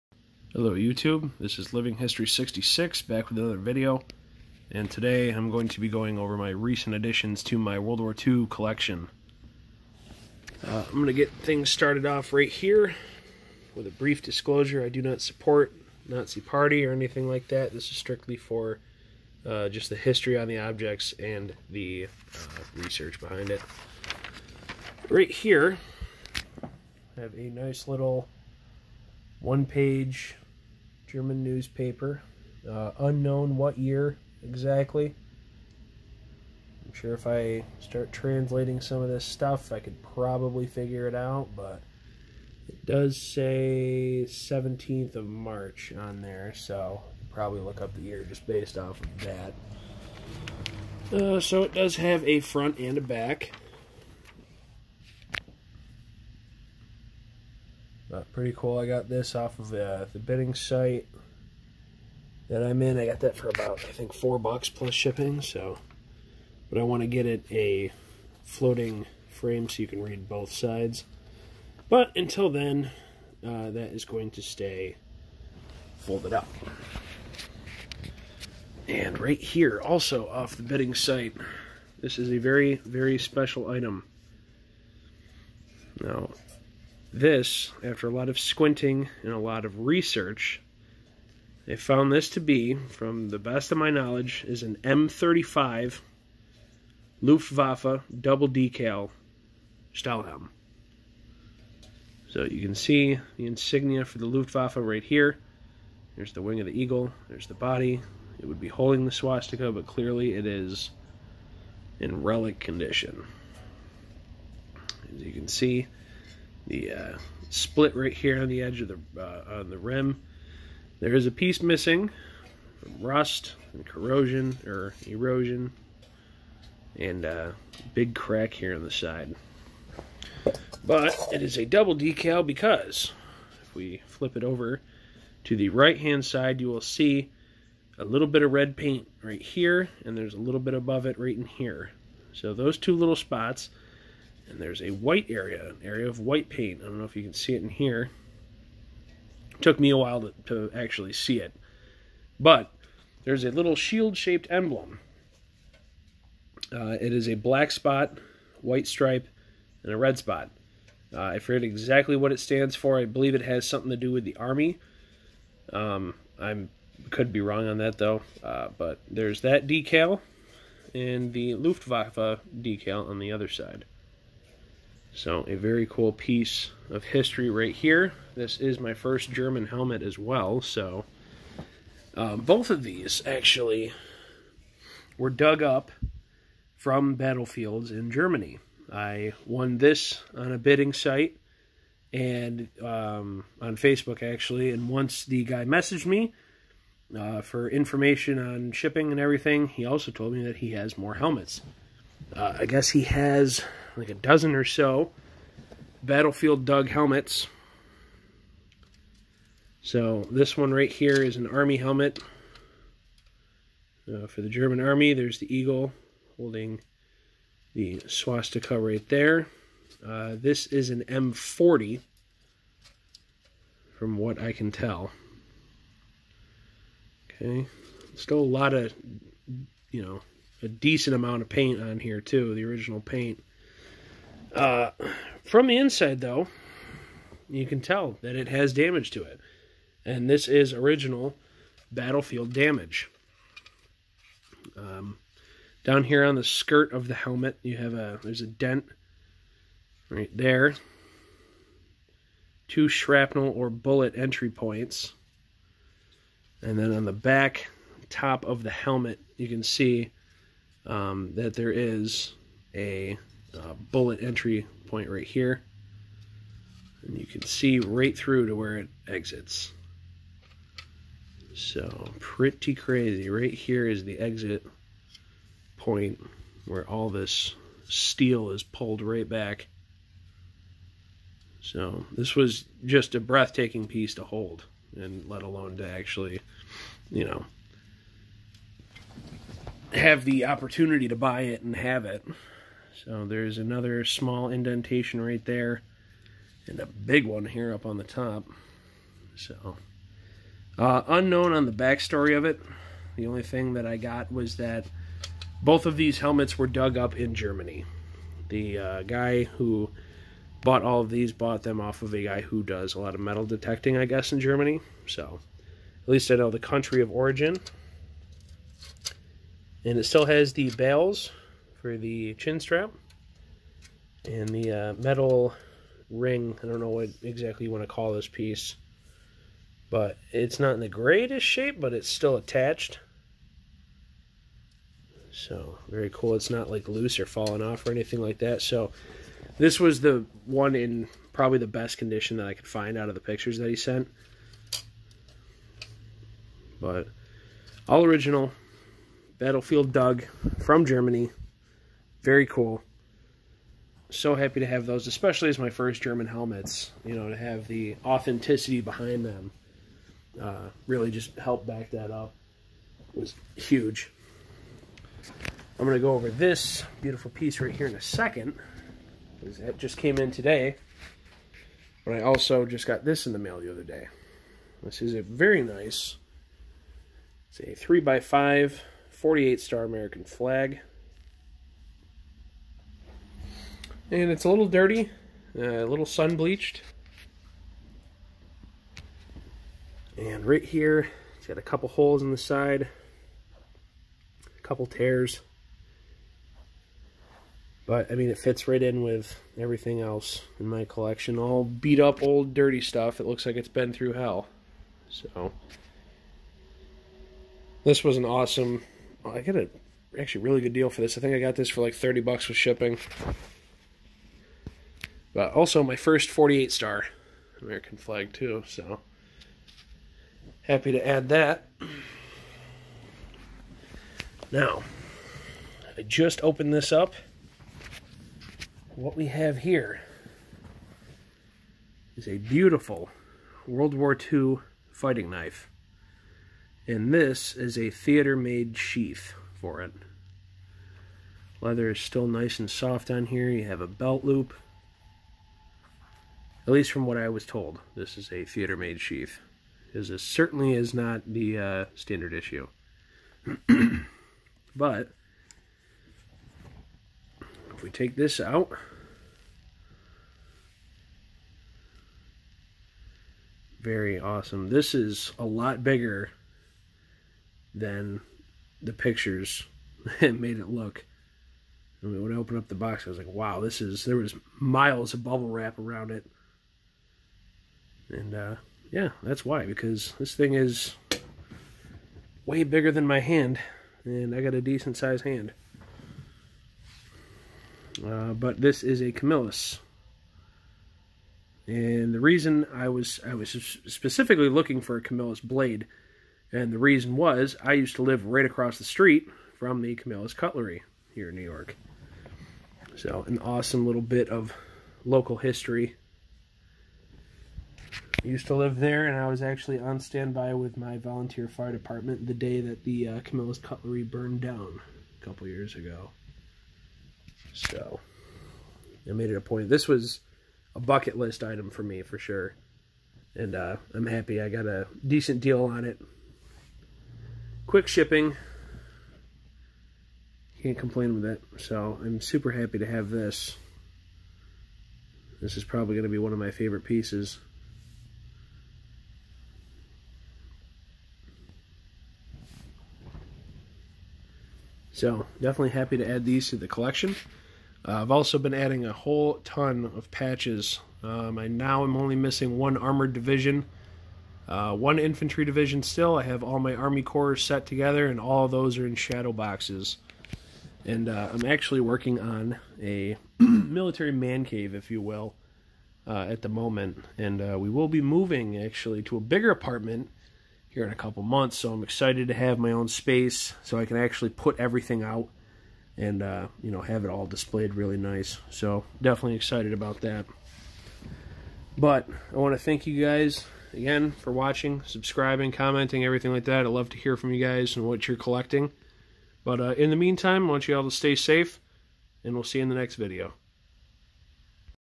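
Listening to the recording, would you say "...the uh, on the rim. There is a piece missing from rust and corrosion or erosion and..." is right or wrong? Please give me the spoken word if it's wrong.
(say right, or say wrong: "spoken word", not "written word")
right.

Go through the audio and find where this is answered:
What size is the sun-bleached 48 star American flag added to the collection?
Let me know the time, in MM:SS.
06:17.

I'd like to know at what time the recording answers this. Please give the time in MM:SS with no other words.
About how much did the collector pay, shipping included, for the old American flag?
06:51.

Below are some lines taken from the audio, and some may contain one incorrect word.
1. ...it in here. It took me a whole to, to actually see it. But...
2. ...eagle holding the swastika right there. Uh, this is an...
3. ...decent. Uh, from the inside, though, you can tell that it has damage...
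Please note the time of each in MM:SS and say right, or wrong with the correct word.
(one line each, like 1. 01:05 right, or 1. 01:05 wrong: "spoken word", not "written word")
1. 02:27 wrong: "while", not "whole"
2. 03:35 right
3. 03:53 wrong: "paint", not "decent".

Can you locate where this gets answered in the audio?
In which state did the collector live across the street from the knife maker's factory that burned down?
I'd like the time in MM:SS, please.
08:21.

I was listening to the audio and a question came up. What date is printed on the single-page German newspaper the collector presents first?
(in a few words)
17th of March.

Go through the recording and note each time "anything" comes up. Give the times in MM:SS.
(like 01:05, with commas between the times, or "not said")
00:16, 05:37.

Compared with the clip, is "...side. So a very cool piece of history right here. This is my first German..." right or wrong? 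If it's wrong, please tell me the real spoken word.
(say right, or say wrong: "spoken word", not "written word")
right.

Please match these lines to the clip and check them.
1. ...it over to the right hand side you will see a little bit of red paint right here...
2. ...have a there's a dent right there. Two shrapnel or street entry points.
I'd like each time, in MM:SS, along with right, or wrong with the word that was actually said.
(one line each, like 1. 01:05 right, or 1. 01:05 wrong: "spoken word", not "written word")
1. 02:14 right
2. 04:07 wrong: "bullet", not "street".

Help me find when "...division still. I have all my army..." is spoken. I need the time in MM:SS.
09:15.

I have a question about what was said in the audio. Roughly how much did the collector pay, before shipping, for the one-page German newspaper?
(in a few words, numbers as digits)
4 bucks.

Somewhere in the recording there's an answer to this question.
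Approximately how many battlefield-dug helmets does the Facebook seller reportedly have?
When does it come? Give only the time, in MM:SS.
03:24.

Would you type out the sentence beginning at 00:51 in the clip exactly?
Uh, so it does have a front and a back.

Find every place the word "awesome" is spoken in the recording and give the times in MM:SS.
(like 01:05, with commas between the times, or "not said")
06:48, 07:44, 08:23.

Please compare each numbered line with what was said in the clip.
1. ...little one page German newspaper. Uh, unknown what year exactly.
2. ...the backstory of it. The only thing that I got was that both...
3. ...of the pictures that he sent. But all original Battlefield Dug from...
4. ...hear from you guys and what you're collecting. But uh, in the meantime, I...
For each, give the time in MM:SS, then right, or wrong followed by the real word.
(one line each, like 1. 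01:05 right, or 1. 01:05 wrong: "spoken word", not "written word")
1. 00:27 right
2. 05:01 right
3. 05:43 right
4. 09:46 right.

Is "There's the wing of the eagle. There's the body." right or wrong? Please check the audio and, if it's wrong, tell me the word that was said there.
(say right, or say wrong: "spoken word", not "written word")
right.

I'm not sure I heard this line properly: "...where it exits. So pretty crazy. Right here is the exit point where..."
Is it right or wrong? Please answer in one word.
right.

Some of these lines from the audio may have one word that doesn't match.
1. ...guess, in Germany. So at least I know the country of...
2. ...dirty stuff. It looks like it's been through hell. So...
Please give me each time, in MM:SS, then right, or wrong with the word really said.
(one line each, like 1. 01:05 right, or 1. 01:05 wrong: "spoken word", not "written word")
1. 05:14 right
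2. 06:42 right.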